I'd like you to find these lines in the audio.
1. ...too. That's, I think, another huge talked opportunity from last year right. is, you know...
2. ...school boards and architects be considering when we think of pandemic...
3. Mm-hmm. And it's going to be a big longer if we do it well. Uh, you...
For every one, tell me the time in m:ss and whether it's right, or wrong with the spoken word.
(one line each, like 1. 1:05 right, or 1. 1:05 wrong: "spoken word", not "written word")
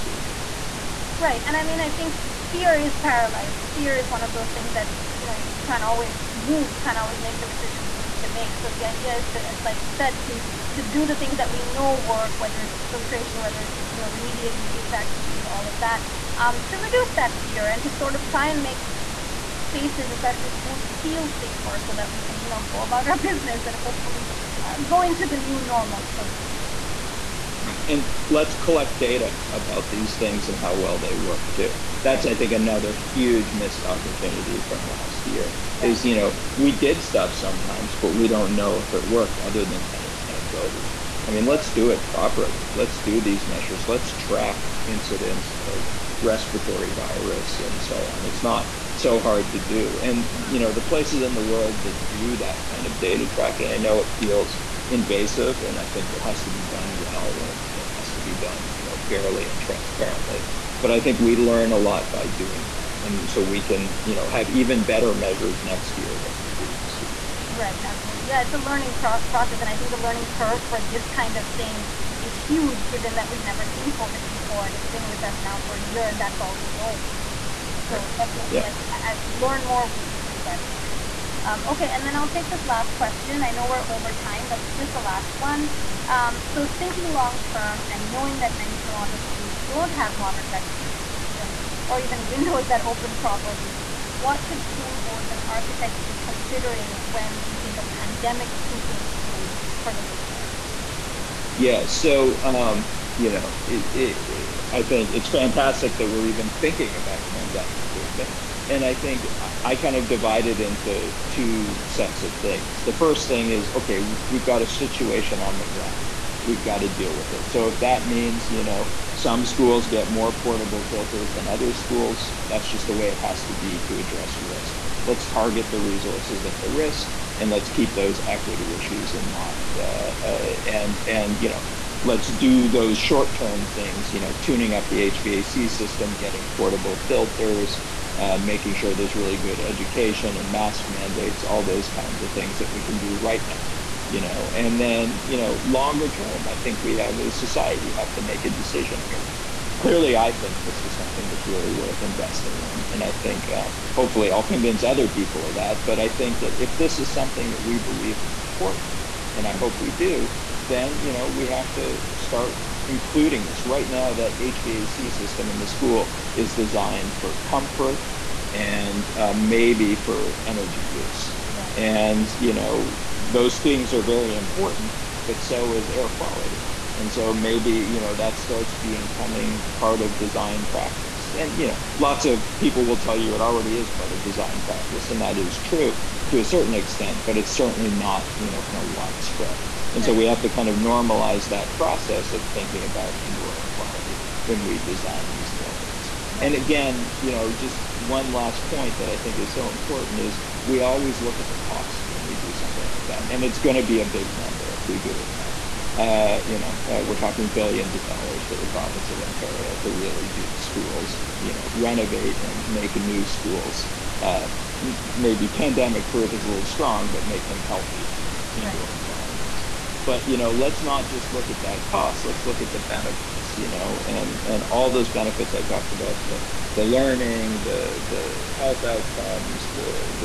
1. 0:31 wrong: "missed", not "talked"
2. 1:34 right
3. 3:23 wrong: "number", not "longer".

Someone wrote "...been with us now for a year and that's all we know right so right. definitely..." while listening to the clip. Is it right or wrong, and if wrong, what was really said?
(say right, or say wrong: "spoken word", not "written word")
right.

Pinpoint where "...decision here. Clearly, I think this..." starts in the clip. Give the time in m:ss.
2:28.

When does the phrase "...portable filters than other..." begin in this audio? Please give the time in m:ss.
2:00.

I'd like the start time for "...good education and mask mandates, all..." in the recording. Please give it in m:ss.
2:19.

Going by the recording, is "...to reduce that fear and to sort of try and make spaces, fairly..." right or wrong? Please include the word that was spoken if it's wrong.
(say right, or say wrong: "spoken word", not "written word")
wrong: "especially", not "fairly".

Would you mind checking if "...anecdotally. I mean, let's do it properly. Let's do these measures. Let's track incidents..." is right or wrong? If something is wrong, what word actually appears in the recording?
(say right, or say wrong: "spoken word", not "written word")
right.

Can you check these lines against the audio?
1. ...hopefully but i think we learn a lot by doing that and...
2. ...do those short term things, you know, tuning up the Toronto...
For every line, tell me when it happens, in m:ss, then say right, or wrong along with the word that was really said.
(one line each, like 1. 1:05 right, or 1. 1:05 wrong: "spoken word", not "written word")
1. 0:59 wrong: "transparently", not "hopefully"
2. 2:12 wrong: "HVAC", not "Toronto".